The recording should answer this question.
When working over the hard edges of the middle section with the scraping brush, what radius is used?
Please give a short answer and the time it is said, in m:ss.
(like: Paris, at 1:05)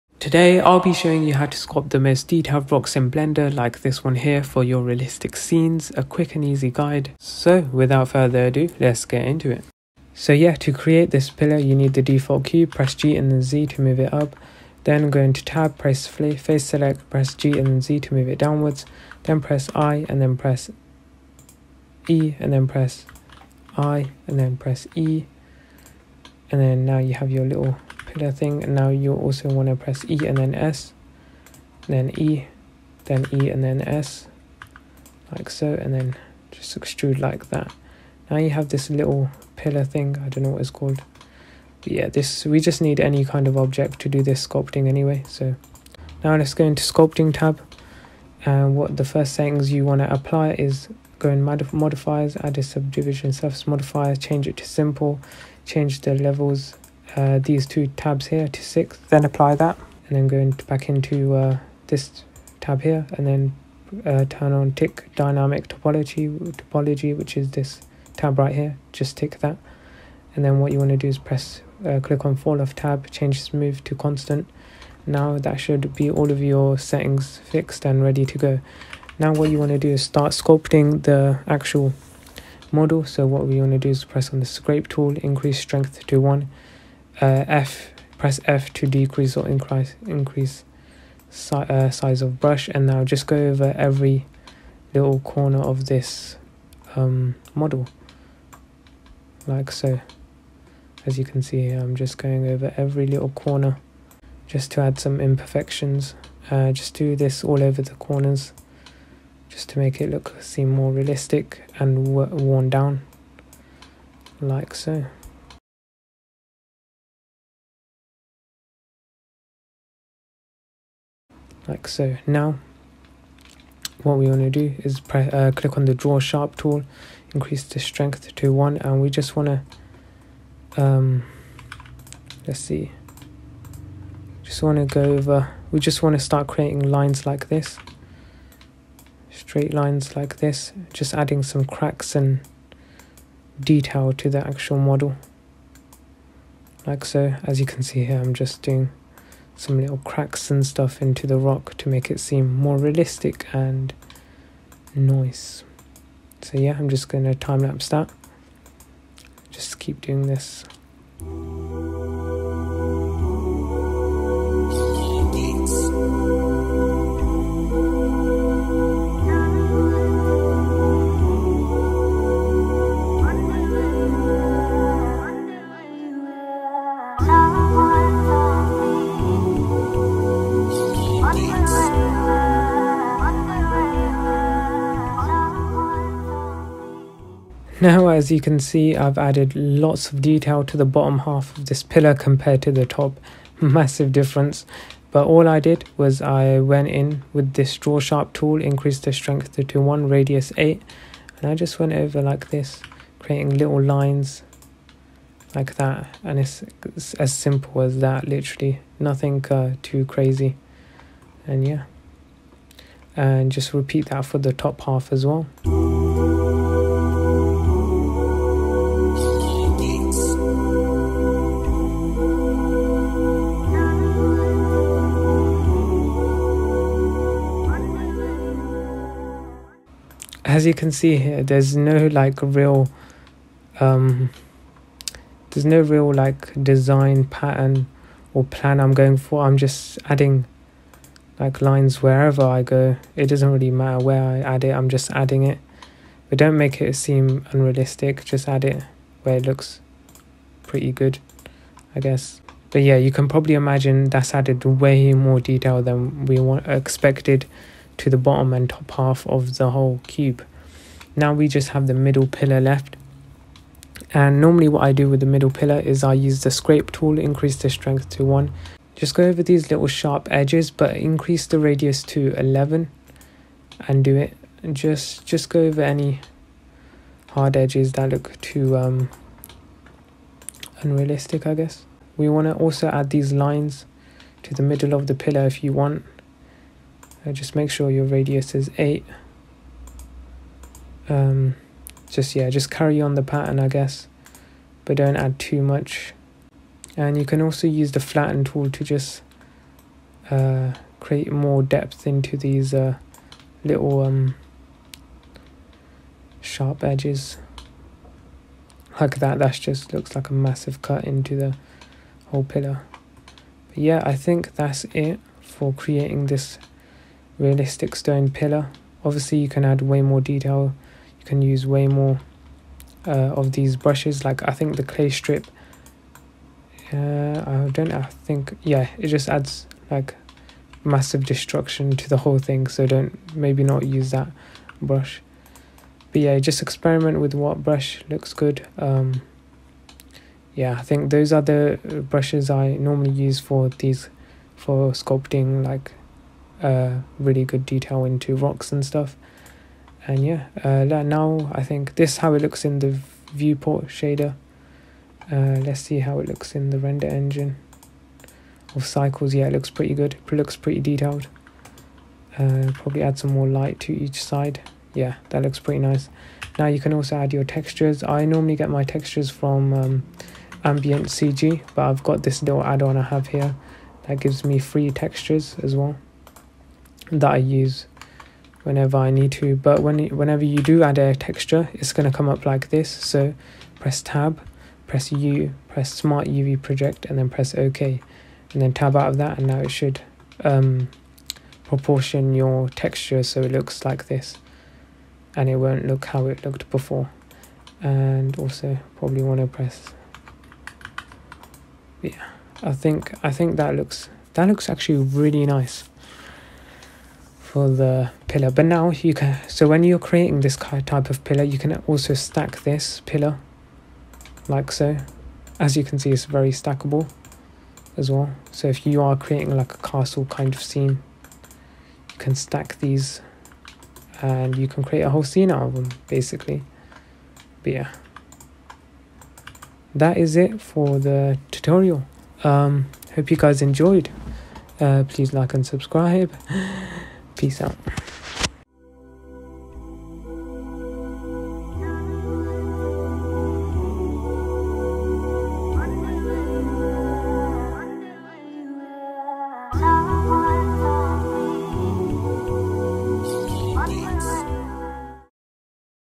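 11, at 4:32.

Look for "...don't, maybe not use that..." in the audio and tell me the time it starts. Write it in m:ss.
5:32.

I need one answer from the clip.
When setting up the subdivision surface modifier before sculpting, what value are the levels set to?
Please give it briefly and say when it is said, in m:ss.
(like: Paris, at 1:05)
6, at 0:58.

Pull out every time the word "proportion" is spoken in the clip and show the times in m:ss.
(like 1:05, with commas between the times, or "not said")
6:31.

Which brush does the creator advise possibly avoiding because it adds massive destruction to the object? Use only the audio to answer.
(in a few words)
clay strip.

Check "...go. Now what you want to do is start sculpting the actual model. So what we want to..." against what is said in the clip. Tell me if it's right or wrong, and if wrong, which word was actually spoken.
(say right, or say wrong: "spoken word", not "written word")
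right.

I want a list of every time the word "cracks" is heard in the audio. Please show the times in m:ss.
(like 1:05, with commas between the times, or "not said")
2:21, 2:29.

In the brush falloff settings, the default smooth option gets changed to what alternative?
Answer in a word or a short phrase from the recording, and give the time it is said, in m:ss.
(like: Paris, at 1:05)
constant, at 1:13.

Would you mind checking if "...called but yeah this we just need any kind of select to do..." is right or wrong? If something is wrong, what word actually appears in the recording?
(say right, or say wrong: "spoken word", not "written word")
wrong: "object", not "select".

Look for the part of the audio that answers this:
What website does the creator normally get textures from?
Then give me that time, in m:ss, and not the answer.
6:10.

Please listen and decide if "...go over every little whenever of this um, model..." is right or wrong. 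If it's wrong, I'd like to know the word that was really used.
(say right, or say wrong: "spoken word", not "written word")
wrong: "corner", not "whenever".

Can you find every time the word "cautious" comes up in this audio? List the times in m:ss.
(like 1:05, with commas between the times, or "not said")
not said.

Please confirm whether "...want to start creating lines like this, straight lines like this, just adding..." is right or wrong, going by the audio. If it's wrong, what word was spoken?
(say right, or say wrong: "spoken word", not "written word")
right.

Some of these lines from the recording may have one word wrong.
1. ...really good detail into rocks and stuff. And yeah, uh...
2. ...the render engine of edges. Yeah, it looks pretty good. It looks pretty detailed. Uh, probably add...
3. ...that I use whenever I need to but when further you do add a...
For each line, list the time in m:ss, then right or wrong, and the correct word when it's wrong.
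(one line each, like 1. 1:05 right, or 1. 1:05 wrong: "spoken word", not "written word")
1. 5:47 right
2. 5:56 wrong: "cycles", not "edges"
3. 6:17 wrong: "whenever", not "further".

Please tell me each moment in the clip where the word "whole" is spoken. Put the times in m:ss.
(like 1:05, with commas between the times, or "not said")
4:19, 5:12, 5:32, 7:05.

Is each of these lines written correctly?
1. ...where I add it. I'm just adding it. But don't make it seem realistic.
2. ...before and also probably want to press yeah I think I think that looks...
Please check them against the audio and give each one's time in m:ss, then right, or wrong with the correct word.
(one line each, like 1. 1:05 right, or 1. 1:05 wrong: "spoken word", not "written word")
1. 4:04 wrong: "unrealistic", not "realistic"
2. 6:36 right.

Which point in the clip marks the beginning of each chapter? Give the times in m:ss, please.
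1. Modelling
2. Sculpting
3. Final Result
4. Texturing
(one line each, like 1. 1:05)
1. 0:10
2. 0:45
3. 7:18
4. 6:00.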